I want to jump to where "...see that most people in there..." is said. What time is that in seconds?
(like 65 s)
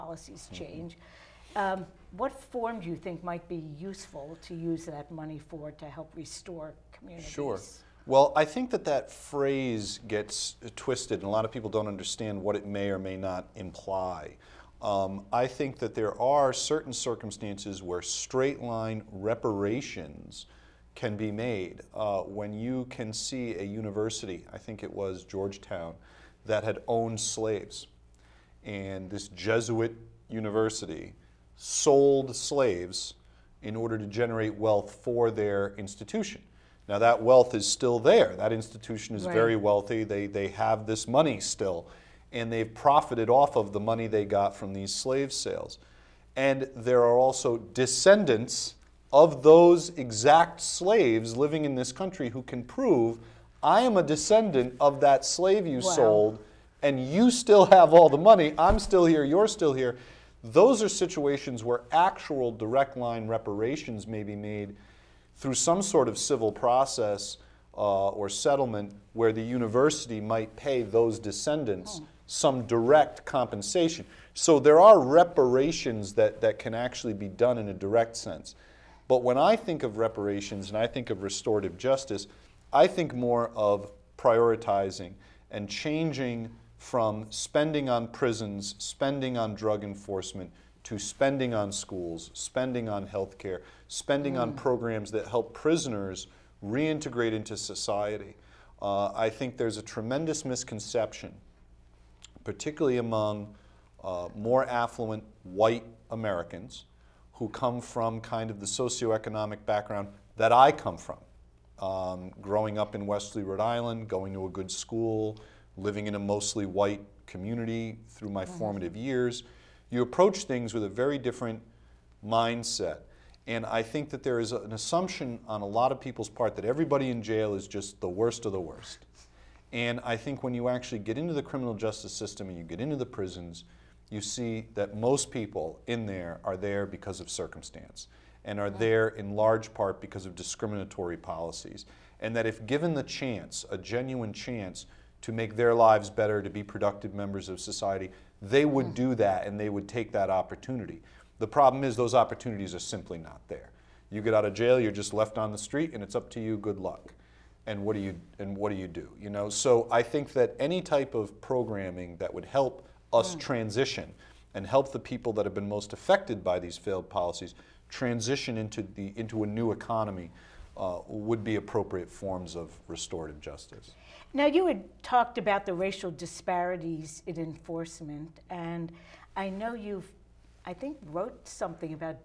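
134 s.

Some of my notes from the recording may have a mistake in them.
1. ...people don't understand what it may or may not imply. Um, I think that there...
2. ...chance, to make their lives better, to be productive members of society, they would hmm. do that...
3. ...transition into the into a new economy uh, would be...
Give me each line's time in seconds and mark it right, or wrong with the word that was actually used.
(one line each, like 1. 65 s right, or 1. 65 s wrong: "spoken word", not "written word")
1. 11 s right
2. 144 s right
3. 167 s right.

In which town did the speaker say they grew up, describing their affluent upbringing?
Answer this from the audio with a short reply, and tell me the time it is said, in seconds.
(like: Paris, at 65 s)
Westerly, Rhode Island, at 113 s.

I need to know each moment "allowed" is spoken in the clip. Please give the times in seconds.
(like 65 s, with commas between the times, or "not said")
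not said.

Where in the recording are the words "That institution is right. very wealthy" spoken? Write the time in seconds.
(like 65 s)
38 s.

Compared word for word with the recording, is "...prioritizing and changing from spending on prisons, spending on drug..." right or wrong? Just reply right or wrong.
right.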